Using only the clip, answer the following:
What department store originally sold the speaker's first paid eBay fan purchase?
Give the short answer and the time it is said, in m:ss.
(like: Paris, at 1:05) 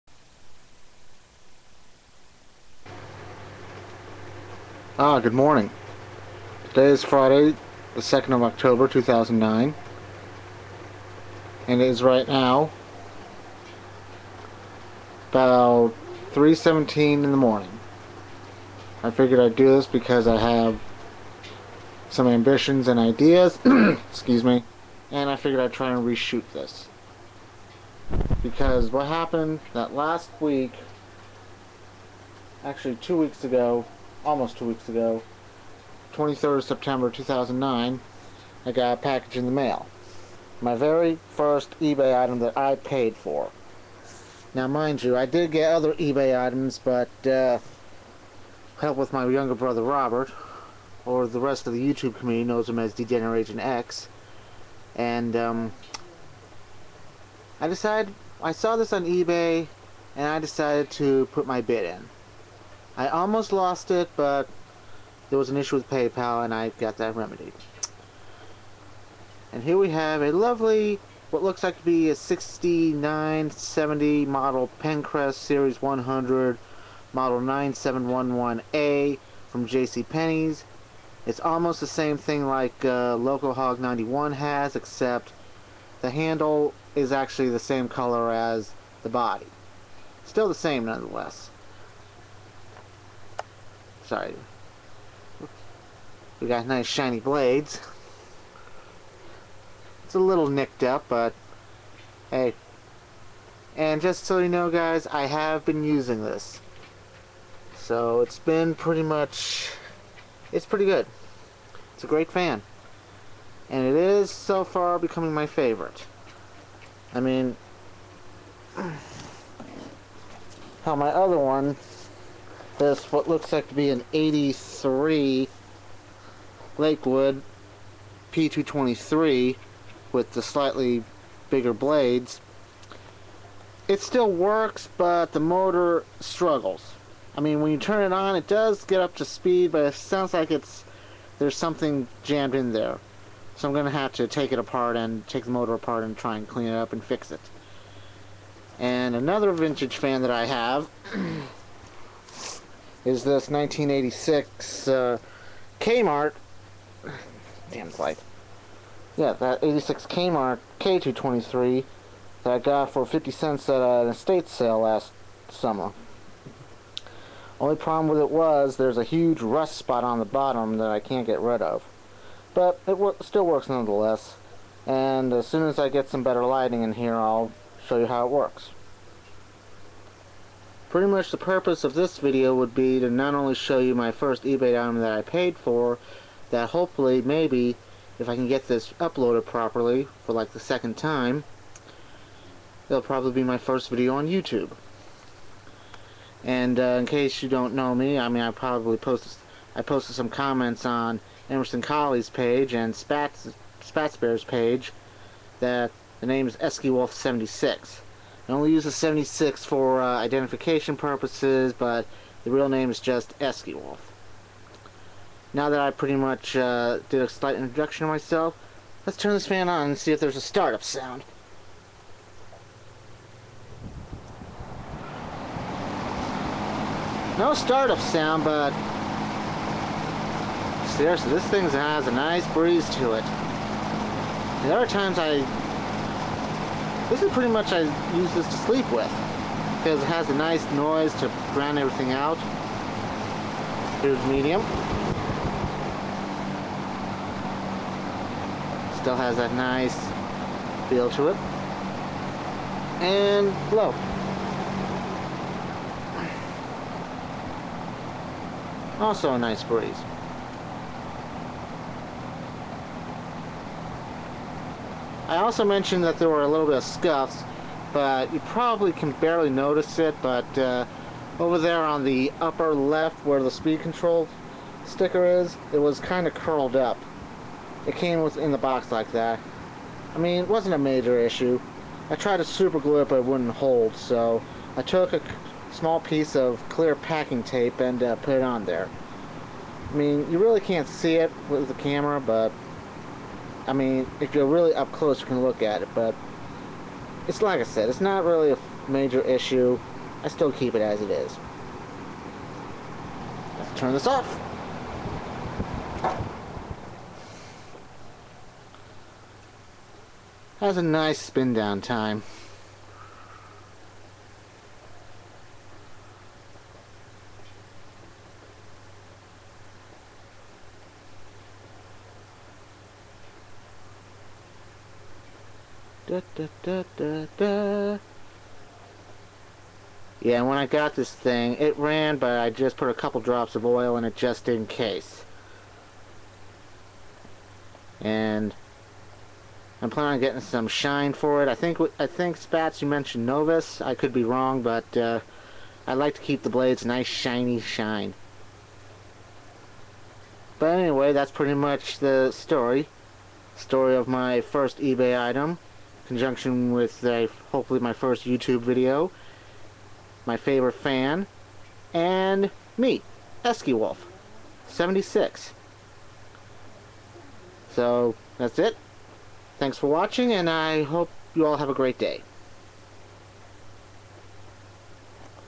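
J.C. Penney's, at 1:19.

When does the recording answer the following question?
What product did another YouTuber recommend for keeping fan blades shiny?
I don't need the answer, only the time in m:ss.
5:43.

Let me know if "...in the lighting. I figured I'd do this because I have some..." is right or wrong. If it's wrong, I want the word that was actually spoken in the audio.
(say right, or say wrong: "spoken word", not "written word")
wrong: "morning", not "lighting".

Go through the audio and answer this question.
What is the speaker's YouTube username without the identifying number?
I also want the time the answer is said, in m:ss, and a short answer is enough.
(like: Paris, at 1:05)
Eskiewolf, at 3:33.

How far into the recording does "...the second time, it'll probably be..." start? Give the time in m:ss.
3:10.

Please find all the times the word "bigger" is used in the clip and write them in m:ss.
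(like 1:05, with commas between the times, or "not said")
2:11.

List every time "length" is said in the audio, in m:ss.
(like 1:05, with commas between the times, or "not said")
not said.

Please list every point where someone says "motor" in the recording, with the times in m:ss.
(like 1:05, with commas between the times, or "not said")
2:15, 2:25.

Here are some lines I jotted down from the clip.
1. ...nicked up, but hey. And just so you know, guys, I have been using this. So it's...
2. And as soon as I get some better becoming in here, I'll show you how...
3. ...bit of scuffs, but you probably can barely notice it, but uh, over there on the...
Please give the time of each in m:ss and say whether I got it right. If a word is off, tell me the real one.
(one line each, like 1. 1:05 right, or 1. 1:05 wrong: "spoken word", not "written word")
1. 1:40 right
2. 2:54 wrong: "lighting", not "becoming"
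3. 4:26 right.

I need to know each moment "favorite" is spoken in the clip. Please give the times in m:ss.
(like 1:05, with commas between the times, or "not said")
1:55, 6:00.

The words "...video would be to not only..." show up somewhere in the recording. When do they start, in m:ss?
3:02.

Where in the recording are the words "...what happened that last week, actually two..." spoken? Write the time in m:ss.
0:28.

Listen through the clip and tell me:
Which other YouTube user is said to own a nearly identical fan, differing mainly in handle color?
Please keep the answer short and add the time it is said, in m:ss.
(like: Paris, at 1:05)
Local Hog 91, at 1:23.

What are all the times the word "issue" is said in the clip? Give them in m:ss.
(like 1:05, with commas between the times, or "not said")
1:05, 4:41, 4:59.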